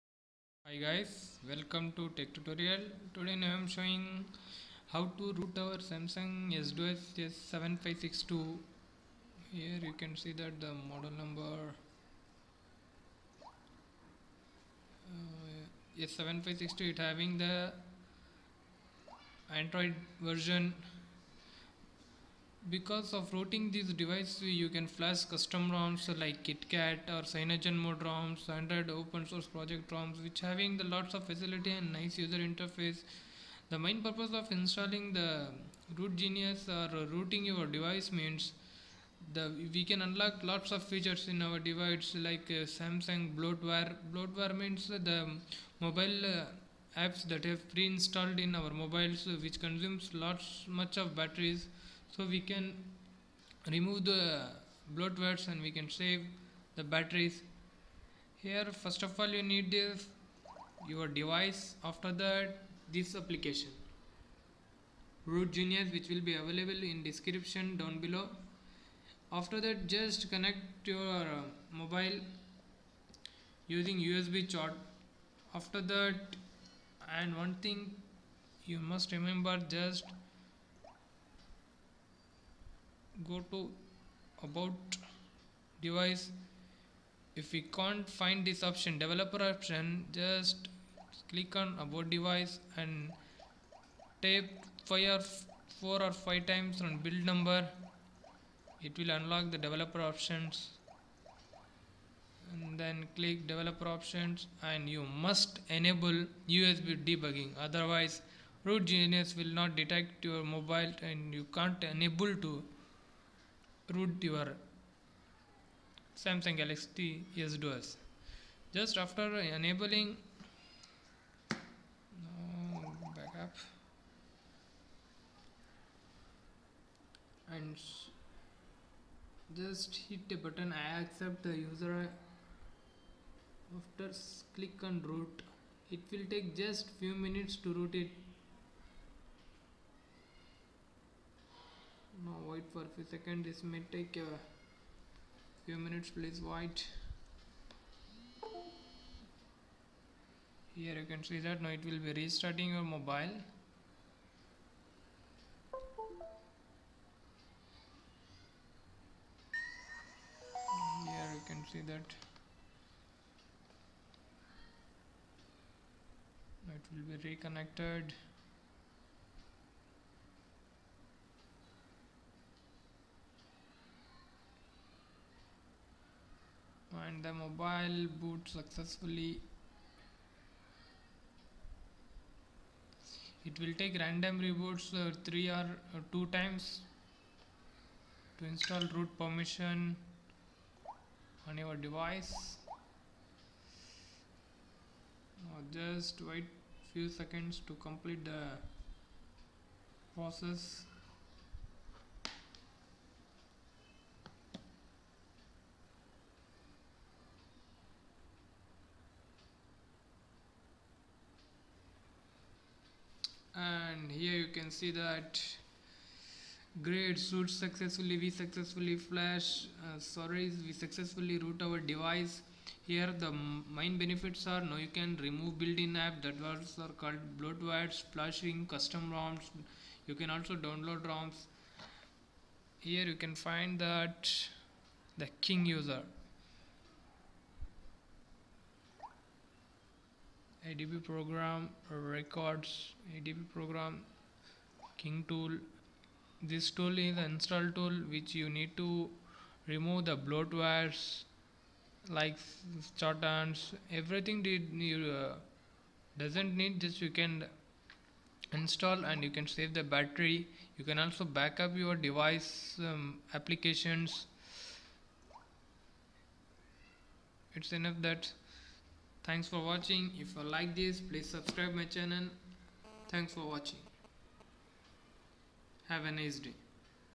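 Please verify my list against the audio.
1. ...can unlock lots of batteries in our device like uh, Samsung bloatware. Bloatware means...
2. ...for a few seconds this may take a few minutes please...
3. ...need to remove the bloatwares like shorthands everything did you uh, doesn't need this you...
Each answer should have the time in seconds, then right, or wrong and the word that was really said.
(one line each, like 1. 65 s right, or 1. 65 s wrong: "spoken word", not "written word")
1. 39 s wrong: "features", not "batteries"
2. 142 s right
3. 248 s right.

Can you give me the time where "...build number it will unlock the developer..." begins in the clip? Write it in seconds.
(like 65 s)
97 s.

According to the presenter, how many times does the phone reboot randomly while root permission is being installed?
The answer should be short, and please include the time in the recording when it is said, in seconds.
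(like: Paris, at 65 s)
3 or 2 times, at 185 s.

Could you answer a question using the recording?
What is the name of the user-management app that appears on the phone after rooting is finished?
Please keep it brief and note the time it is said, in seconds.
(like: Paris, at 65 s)
King User, at 235 s.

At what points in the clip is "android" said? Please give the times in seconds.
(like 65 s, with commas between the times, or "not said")
19 s, 28 s.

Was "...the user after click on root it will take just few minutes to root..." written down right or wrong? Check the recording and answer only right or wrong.
right.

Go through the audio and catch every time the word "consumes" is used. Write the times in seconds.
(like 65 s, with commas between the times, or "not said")
49 s.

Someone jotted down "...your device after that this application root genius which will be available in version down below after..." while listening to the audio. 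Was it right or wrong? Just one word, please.
wrong.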